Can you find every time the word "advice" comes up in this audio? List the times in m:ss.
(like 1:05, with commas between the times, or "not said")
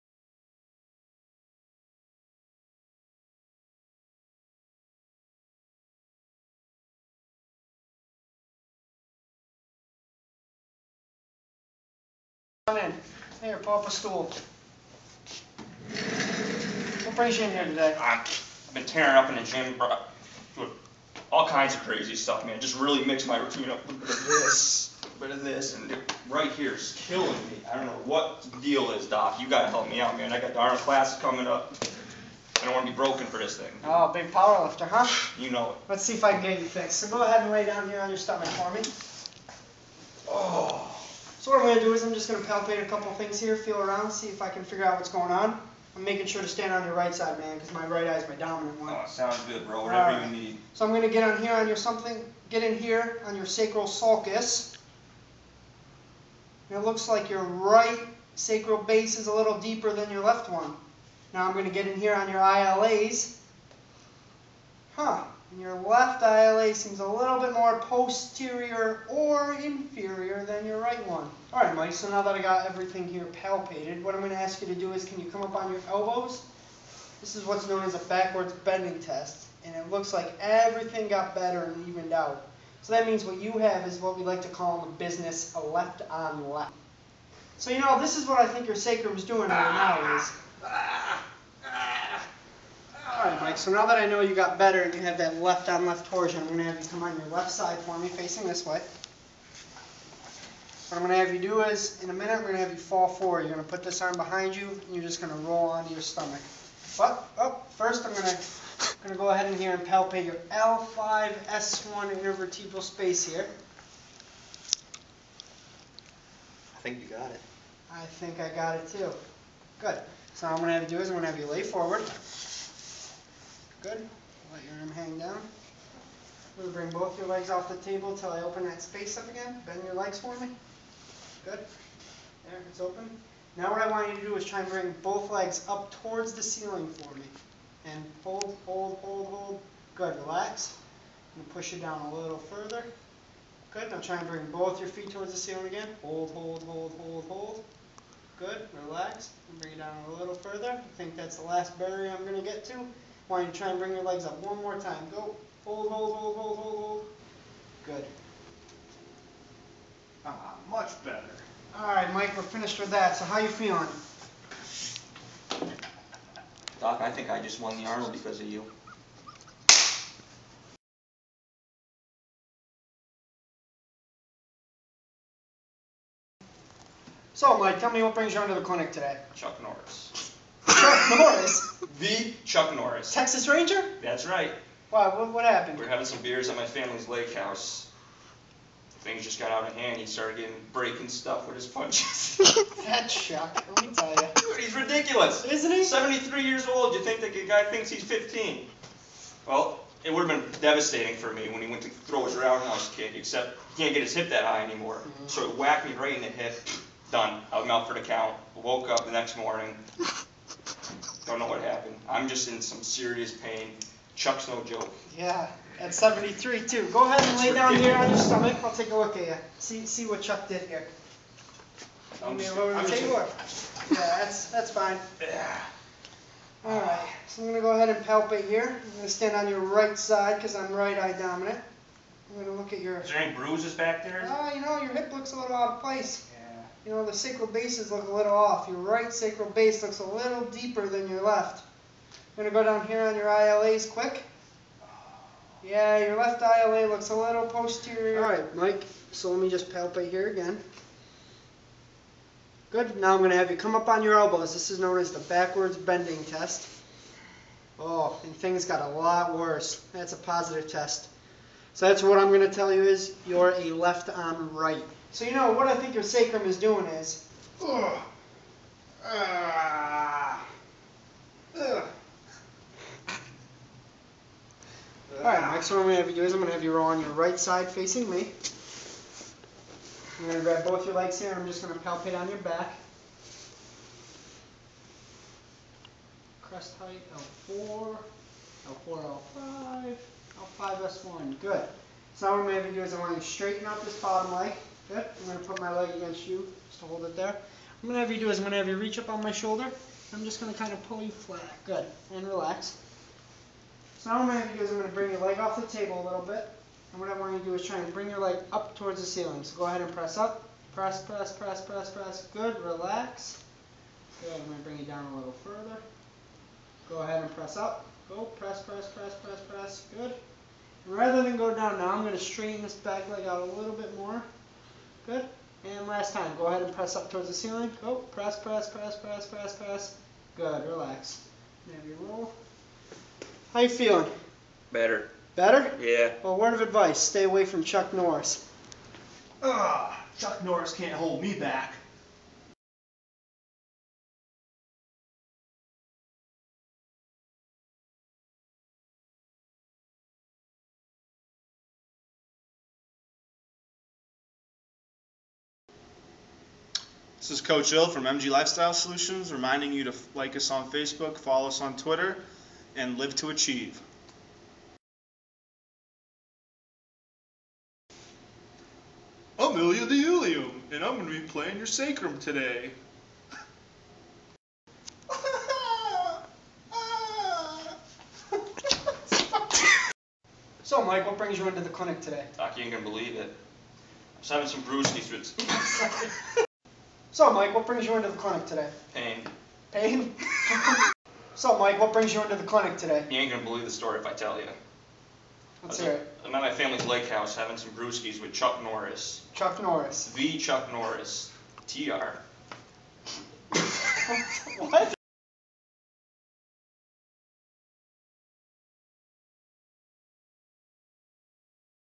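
5:36.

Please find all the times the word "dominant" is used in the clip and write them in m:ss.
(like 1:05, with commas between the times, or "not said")
0:48, 3:51.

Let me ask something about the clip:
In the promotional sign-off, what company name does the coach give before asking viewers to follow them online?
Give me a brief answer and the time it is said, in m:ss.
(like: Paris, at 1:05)
MG Lifestyle Solutions, at 5:58.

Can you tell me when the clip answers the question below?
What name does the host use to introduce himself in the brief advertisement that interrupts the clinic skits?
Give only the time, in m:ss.
5:57.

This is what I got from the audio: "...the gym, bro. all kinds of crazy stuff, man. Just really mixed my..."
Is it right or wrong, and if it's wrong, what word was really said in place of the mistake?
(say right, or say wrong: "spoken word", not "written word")
right.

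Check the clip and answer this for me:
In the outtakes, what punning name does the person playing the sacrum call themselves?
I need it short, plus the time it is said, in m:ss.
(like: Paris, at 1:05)
Ilya the Ilium, at 6:09.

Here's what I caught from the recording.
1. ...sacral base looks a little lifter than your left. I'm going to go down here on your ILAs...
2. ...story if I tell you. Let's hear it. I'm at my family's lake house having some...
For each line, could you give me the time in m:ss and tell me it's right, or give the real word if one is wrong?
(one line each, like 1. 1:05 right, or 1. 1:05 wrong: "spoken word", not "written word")
1. 3:59 wrong: "deeper", not "lifter"
2. 6:33 right.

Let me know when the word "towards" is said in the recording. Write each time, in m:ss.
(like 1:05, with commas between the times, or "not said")
2:16, 2:25, 5:08, 5:27.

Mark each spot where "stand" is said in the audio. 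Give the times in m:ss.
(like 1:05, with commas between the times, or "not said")
0:46, 3:49.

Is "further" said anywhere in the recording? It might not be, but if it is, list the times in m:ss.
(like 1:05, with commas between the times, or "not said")
2:22, 2:30, 5:15.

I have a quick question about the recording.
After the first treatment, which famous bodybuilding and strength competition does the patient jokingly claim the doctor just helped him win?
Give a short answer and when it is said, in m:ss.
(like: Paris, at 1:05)
The Arnold, at 2:47.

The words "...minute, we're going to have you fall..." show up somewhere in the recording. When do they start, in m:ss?
1:42.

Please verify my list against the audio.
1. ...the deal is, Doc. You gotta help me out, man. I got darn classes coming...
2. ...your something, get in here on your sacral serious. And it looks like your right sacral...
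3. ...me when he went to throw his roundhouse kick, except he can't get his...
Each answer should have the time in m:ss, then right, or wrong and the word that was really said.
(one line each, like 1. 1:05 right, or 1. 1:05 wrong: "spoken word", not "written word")
1. 0:28 right
2. 0:51 wrong: "sulcus", not "serious"
3. 3:21 right.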